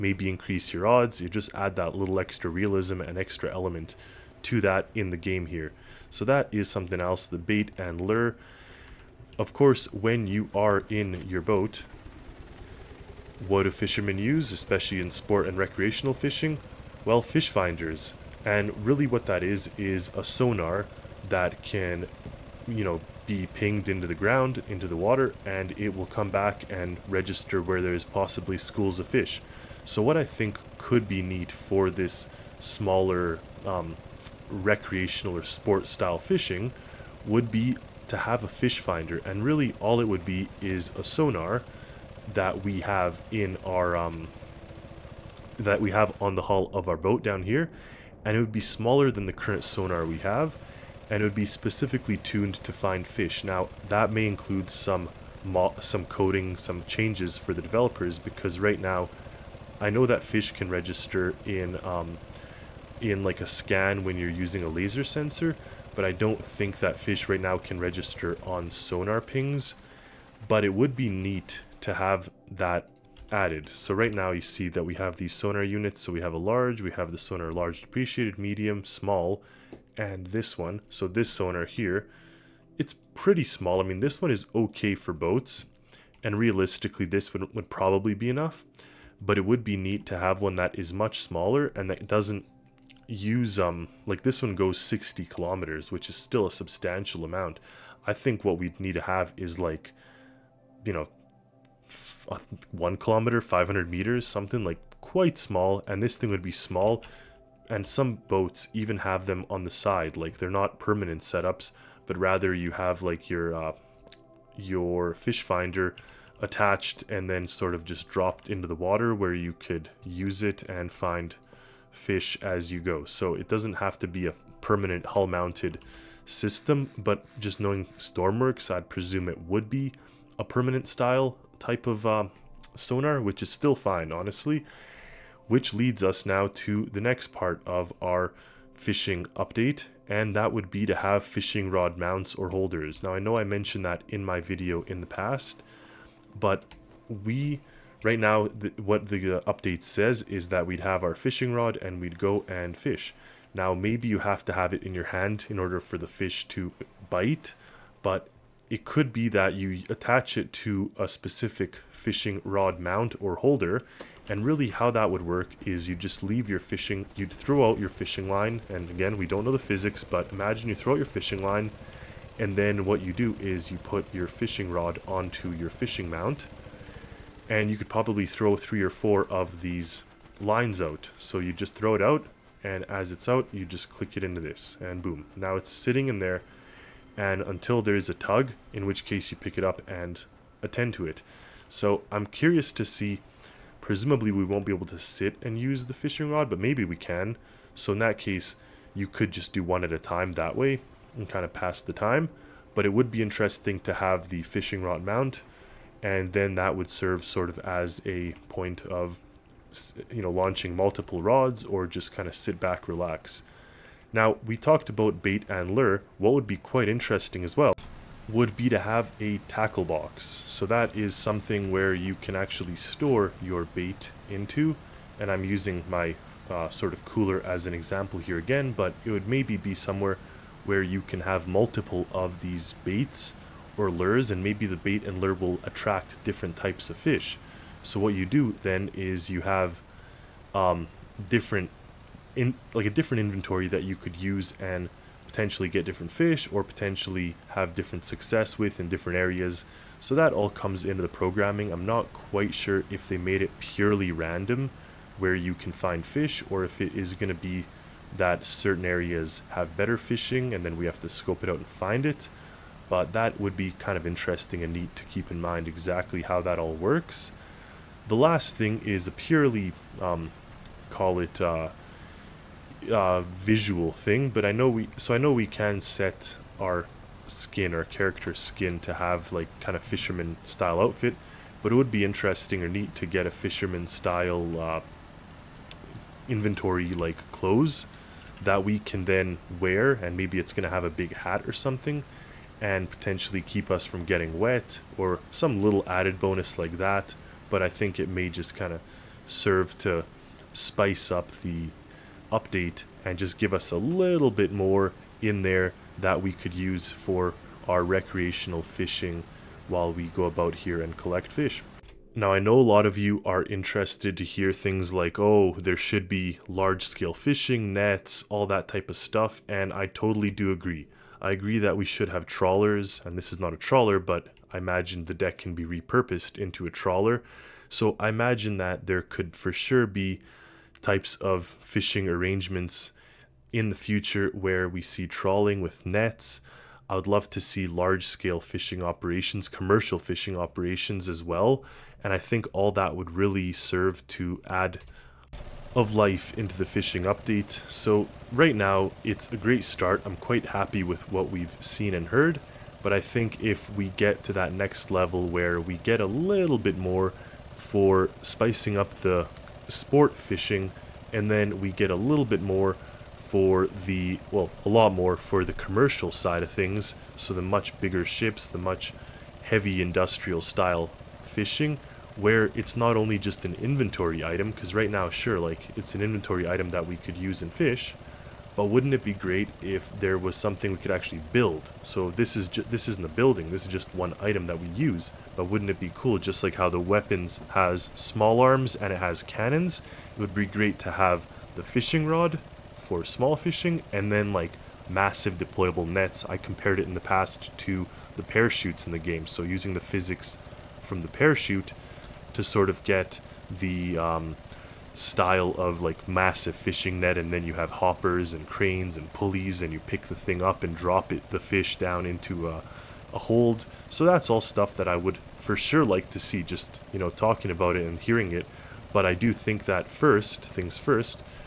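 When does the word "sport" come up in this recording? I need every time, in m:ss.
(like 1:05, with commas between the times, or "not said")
0:15, 0:35, 5:59.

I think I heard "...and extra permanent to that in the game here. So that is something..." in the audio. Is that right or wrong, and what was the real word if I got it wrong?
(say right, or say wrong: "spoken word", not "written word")
wrong: "element", not "permanent".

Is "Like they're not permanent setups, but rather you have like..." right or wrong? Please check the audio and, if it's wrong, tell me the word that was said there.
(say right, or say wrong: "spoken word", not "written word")
right.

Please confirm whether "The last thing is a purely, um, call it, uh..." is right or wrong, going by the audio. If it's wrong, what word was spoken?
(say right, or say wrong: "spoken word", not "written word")
right.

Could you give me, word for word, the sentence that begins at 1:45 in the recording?
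And this thing would be small.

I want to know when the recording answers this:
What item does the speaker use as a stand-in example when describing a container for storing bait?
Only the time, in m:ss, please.
3:47.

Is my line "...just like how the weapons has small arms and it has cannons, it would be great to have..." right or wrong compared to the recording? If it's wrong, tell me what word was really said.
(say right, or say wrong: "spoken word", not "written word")
right.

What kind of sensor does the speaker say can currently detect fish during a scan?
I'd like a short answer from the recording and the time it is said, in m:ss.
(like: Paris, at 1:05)
laser sensor, at 1:04.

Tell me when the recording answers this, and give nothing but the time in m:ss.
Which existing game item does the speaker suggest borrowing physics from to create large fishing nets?
6:38.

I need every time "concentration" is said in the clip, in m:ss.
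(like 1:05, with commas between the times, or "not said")
not said.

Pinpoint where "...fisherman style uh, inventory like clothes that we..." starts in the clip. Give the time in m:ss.
4:43.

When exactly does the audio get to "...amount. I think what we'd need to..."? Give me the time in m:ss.
1:37.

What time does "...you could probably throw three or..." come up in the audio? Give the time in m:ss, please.
2:57.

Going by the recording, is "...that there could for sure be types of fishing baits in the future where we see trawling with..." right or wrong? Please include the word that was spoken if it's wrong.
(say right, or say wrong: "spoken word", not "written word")
wrong: "arrangements", not "baits".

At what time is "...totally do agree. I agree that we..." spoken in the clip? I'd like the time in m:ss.
5:19.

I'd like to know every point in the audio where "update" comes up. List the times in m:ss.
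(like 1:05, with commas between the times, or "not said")
2:19, 2:29, 5:02, 5:47.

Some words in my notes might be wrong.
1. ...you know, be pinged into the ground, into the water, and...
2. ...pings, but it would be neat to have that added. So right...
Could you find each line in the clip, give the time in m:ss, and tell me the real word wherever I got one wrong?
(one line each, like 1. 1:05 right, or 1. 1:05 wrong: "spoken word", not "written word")
1. 0:22 right
2. 1:09 right.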